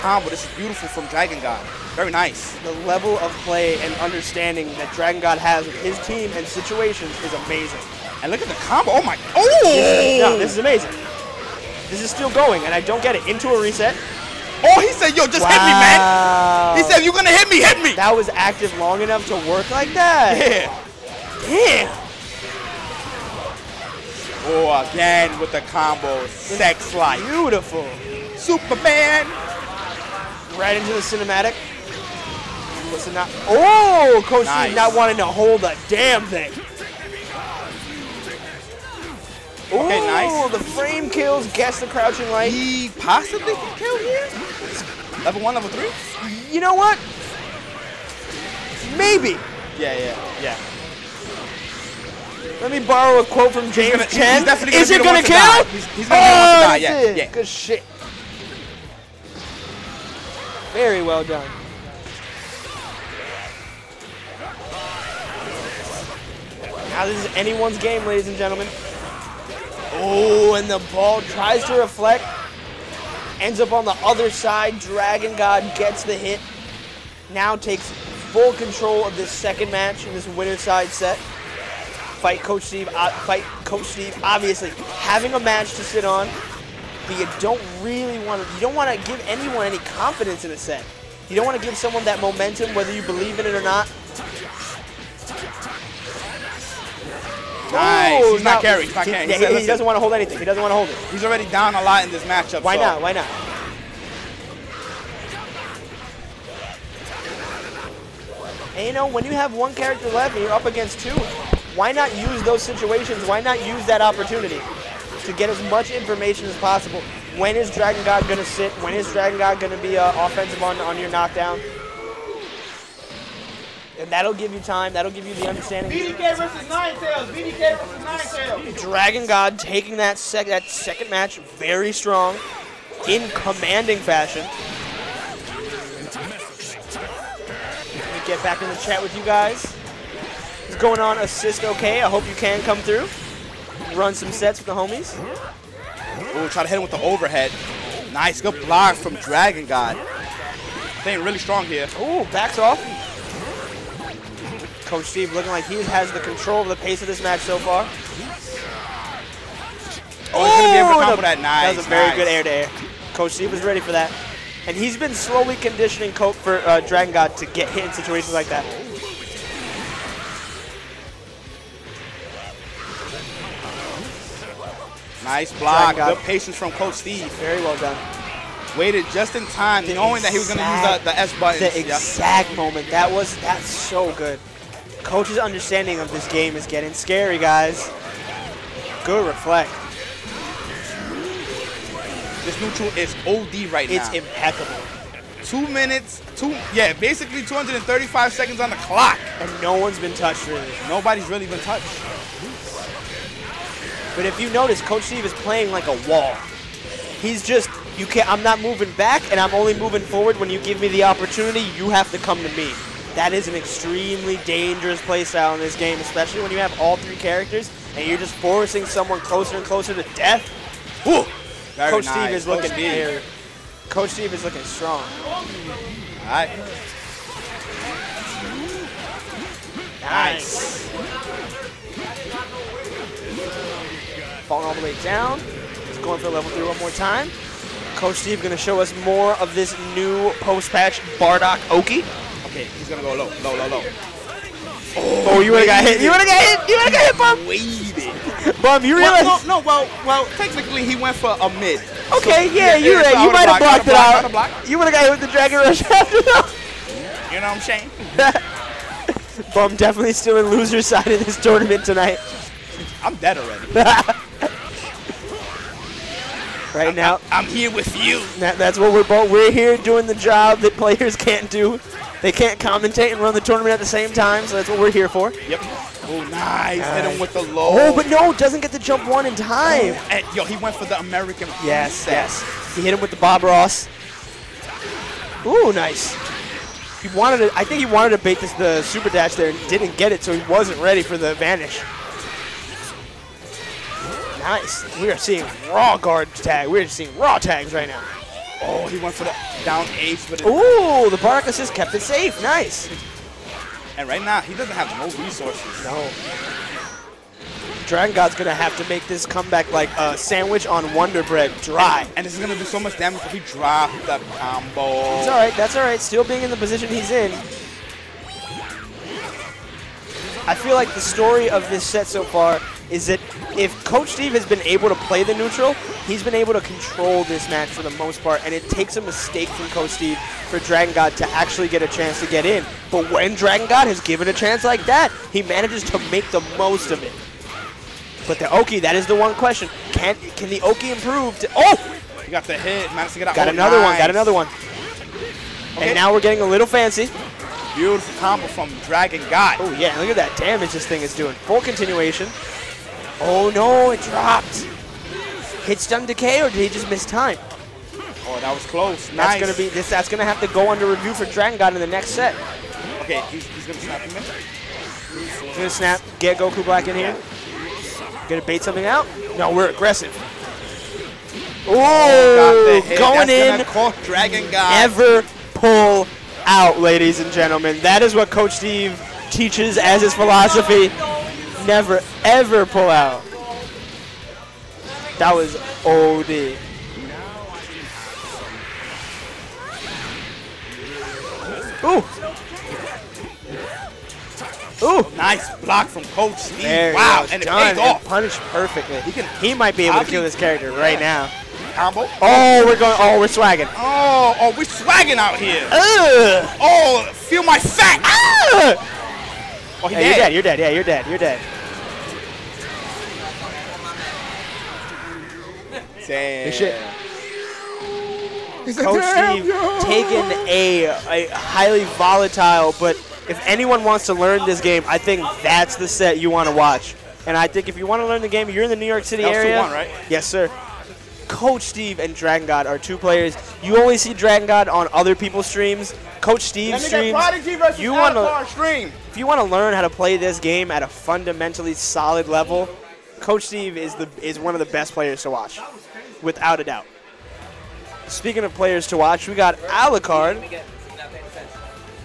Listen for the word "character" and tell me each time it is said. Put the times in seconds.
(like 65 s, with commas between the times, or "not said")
109 s, 217 s, 400 s.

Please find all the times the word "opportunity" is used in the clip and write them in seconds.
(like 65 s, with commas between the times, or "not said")
114 s, 211 s.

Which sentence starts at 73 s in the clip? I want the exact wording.
Ends up on the other side.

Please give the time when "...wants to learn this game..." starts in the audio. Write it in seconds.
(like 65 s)
423 s.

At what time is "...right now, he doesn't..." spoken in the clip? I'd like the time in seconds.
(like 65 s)
304 s.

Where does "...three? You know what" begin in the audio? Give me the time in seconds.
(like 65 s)
45 s.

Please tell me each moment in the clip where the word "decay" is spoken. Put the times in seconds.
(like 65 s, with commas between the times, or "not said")
356 s.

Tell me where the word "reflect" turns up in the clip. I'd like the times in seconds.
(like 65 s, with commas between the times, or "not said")
71 s, 189 s.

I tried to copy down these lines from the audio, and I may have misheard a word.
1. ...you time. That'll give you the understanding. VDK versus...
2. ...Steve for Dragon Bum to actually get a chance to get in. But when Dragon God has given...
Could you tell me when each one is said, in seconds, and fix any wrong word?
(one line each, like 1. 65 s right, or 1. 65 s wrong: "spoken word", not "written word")
1. 124 s right
2. 329 s wrong: "God", not "Bum".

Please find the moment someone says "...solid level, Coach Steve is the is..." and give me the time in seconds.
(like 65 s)
441 s.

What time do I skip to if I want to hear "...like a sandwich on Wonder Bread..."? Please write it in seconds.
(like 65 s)
309 s.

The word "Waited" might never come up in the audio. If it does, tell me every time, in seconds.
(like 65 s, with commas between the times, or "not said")
178 s, 247 s.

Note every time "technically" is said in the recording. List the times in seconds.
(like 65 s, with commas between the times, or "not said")
250 s.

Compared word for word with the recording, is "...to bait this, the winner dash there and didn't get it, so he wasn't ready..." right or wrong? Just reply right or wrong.
wrong.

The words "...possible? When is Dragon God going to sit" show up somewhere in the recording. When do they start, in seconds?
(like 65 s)
116 s.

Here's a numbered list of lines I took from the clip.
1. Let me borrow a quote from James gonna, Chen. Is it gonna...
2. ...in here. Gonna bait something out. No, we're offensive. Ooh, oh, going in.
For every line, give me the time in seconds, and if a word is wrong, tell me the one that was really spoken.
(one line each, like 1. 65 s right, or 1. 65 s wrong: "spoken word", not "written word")
1. 52 s right
2. 366 s wrong: "aggressive", not "offensive".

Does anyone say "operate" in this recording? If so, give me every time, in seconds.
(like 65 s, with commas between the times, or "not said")
not said.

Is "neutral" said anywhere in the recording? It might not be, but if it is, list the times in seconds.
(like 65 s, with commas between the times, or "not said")
192 s, 325 s.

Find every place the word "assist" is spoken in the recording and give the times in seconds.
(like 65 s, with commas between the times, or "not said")
141 s, 301 s.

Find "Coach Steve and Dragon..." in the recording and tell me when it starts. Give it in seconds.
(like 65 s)
431 s.